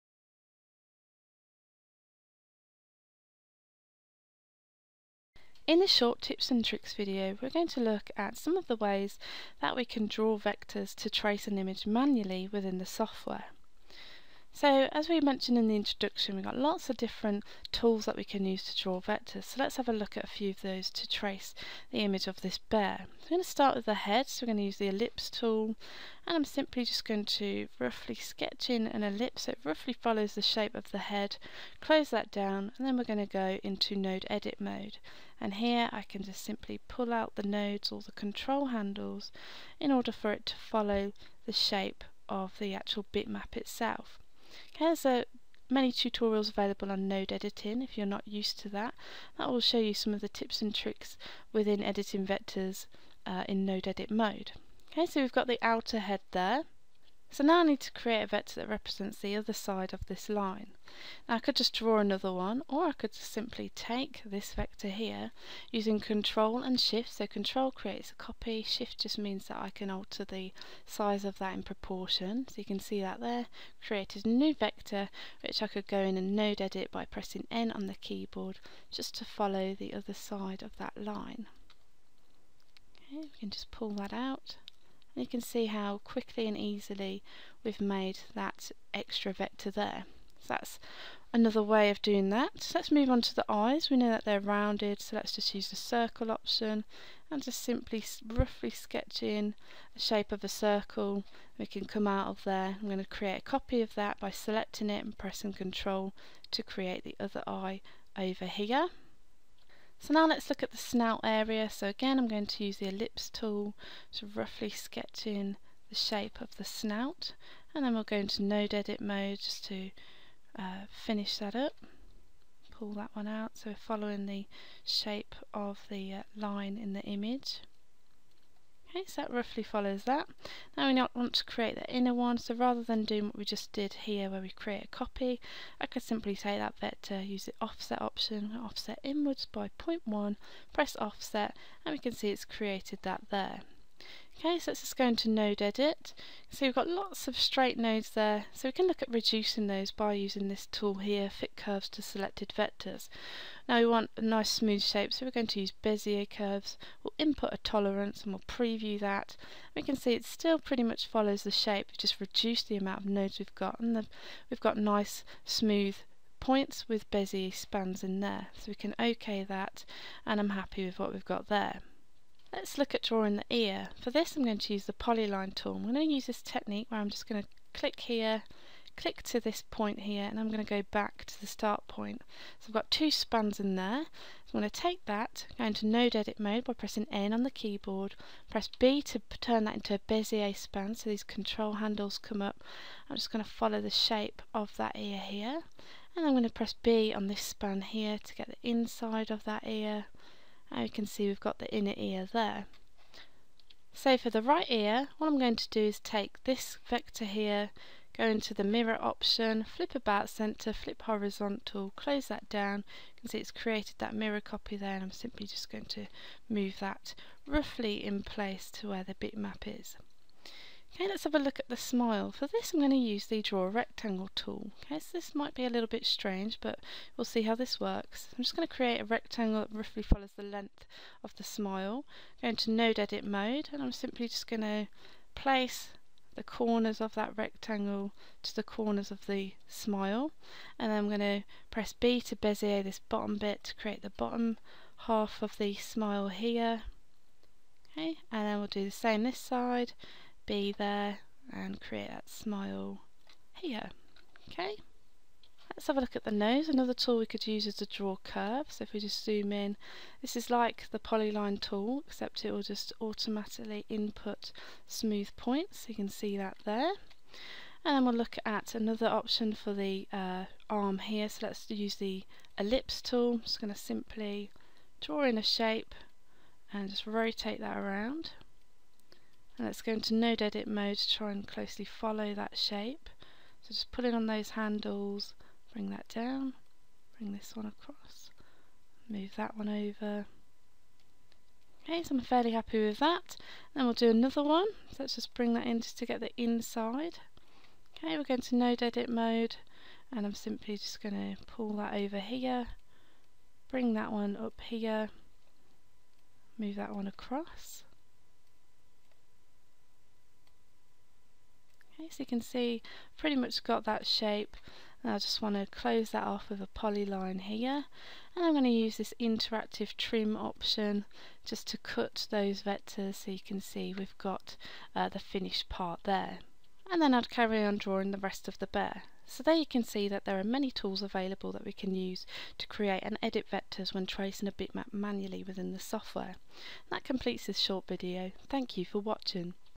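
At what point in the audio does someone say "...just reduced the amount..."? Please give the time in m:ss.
2:41.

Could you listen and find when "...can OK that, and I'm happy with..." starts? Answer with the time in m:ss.
2:48.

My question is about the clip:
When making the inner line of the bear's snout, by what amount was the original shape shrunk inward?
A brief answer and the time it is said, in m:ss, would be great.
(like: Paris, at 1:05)
0.1, at 2:19.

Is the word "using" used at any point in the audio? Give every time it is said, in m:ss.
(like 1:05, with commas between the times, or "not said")
1:05, 2:30.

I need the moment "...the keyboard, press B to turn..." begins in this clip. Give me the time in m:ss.
3:07.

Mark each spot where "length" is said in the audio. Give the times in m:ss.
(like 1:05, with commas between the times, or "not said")
3:50.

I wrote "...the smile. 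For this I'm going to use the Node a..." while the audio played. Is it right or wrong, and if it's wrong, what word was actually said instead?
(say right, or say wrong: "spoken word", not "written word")
wrong: "Draw", not "Node".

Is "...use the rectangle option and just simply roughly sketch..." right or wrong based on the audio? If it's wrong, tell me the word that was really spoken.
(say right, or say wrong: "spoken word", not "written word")
wrong: "circle", not "rectangle".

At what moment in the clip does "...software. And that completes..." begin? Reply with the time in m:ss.
5:35.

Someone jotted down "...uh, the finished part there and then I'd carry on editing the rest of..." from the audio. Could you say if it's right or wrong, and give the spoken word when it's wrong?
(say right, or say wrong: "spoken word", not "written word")
wrong: "drawing", not "editing".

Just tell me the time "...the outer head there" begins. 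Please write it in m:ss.
0:55.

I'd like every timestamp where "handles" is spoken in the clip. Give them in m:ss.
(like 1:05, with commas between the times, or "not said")
0:38, 3:11, 4:44.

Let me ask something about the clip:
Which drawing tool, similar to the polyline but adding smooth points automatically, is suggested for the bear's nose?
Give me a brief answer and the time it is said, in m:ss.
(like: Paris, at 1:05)
Draw curve, at 4:17.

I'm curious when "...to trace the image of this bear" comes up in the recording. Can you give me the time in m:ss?
0:20.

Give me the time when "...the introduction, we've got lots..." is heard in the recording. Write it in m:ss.
0:15.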